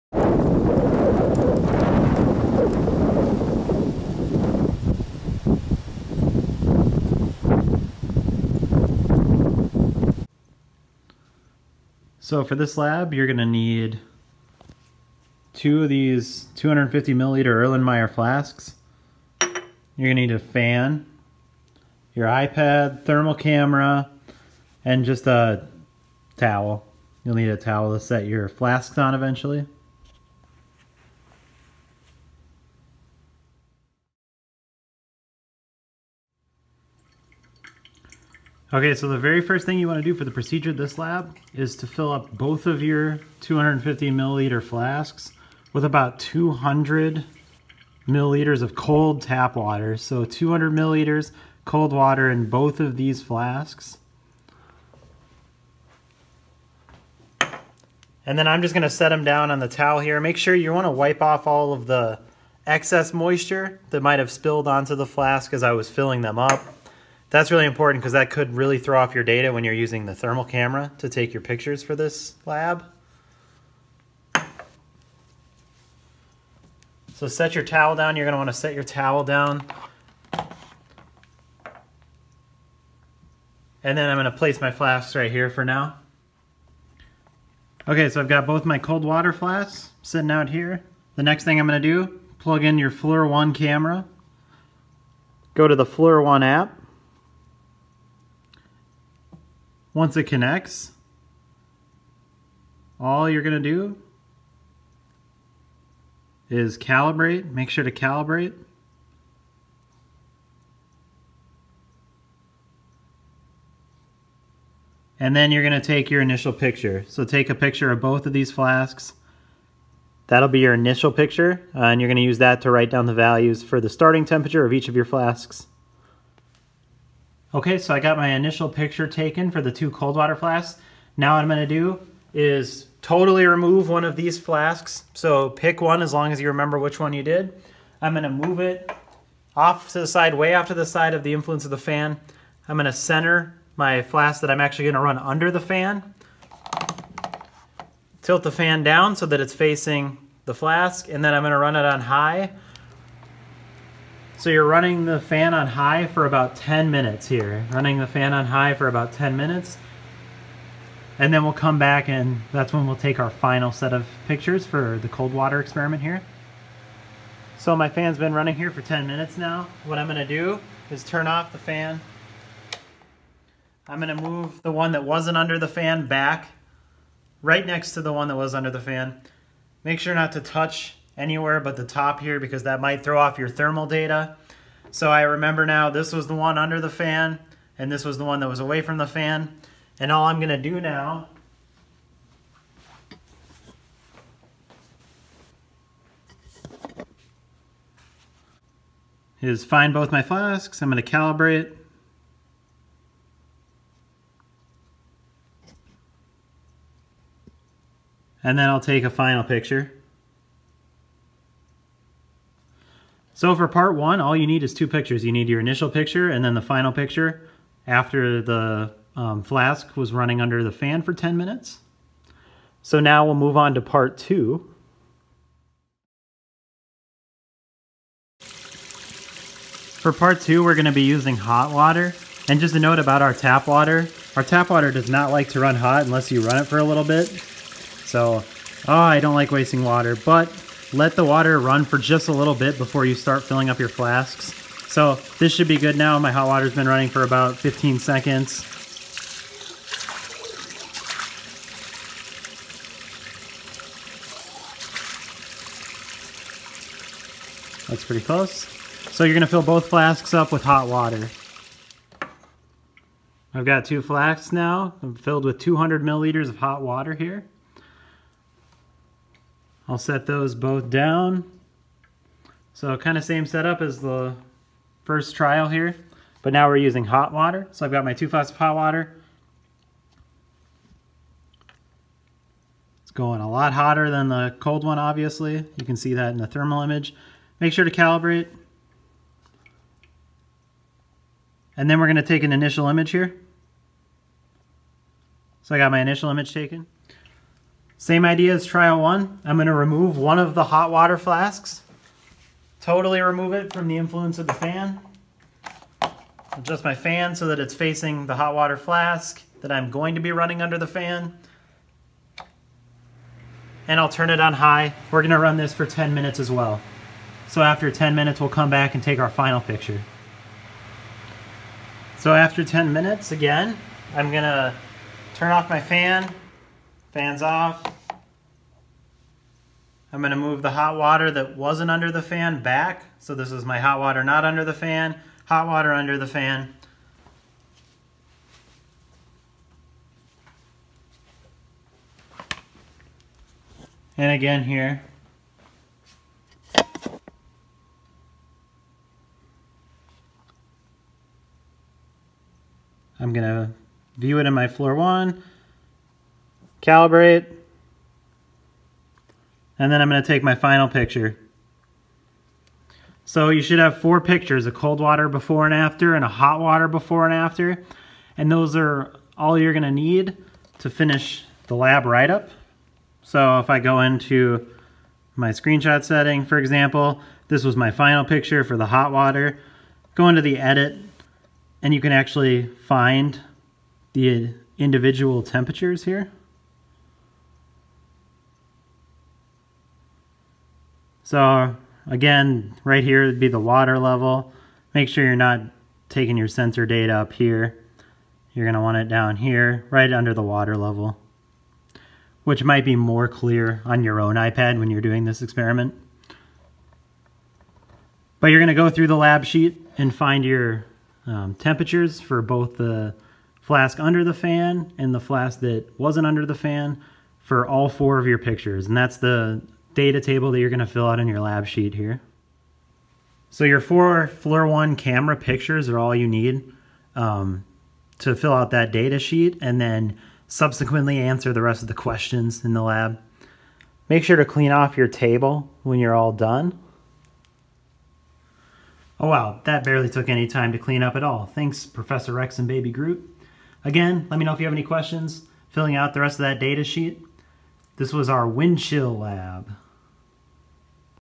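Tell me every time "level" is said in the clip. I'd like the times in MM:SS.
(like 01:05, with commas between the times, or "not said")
06:33, 06:40.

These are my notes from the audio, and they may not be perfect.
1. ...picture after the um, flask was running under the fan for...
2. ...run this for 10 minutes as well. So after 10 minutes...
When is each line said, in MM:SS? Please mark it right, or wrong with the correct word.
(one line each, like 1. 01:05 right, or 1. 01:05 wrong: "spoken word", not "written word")
1. 03:36 right
2. 05:15 right.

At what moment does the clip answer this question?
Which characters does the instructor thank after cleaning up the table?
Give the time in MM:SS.
07:21.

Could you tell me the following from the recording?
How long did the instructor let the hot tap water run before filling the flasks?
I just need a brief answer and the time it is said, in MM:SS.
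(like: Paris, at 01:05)
15 seconds, at 04:07.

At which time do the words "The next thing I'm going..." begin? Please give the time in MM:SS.
01:31.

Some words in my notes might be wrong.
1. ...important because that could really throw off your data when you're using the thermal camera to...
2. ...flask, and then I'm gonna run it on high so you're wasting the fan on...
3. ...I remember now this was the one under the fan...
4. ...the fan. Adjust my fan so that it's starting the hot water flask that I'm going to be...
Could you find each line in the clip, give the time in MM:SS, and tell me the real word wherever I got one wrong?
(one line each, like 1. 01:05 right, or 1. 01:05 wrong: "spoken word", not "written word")
1. 01:07 right
2. 02:30 wrong: "running", not "wasting"
3. 03:05 right
4. 05:04 wrong: "facing", not "starting".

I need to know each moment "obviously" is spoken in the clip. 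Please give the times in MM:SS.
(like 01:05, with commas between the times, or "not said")
04:44.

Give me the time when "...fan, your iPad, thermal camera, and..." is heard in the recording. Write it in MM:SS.
00:20.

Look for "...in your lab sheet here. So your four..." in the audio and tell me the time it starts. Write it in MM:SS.
07:01.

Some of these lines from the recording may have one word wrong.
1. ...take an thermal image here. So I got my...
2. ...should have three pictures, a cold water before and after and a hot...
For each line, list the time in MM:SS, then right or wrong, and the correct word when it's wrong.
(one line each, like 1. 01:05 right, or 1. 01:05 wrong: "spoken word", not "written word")
1. 04:52 wrong: "initial", not "thermal"
2. 06:03 wrong: "four", not "three".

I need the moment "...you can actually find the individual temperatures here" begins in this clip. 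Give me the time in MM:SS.
06:21.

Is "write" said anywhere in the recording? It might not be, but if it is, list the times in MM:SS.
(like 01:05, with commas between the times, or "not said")
02:02, 06:12.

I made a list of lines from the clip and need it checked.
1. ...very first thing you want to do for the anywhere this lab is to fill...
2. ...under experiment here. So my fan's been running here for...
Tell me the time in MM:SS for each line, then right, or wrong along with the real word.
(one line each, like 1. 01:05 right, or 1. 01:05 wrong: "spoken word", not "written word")
1. 00:39 wrong: "procedure", not "anywhere"
2. 02:45 wrong: "water", not "under".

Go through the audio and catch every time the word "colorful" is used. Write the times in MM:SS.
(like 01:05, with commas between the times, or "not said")
not said.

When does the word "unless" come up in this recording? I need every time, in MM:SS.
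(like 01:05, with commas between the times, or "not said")
03:56.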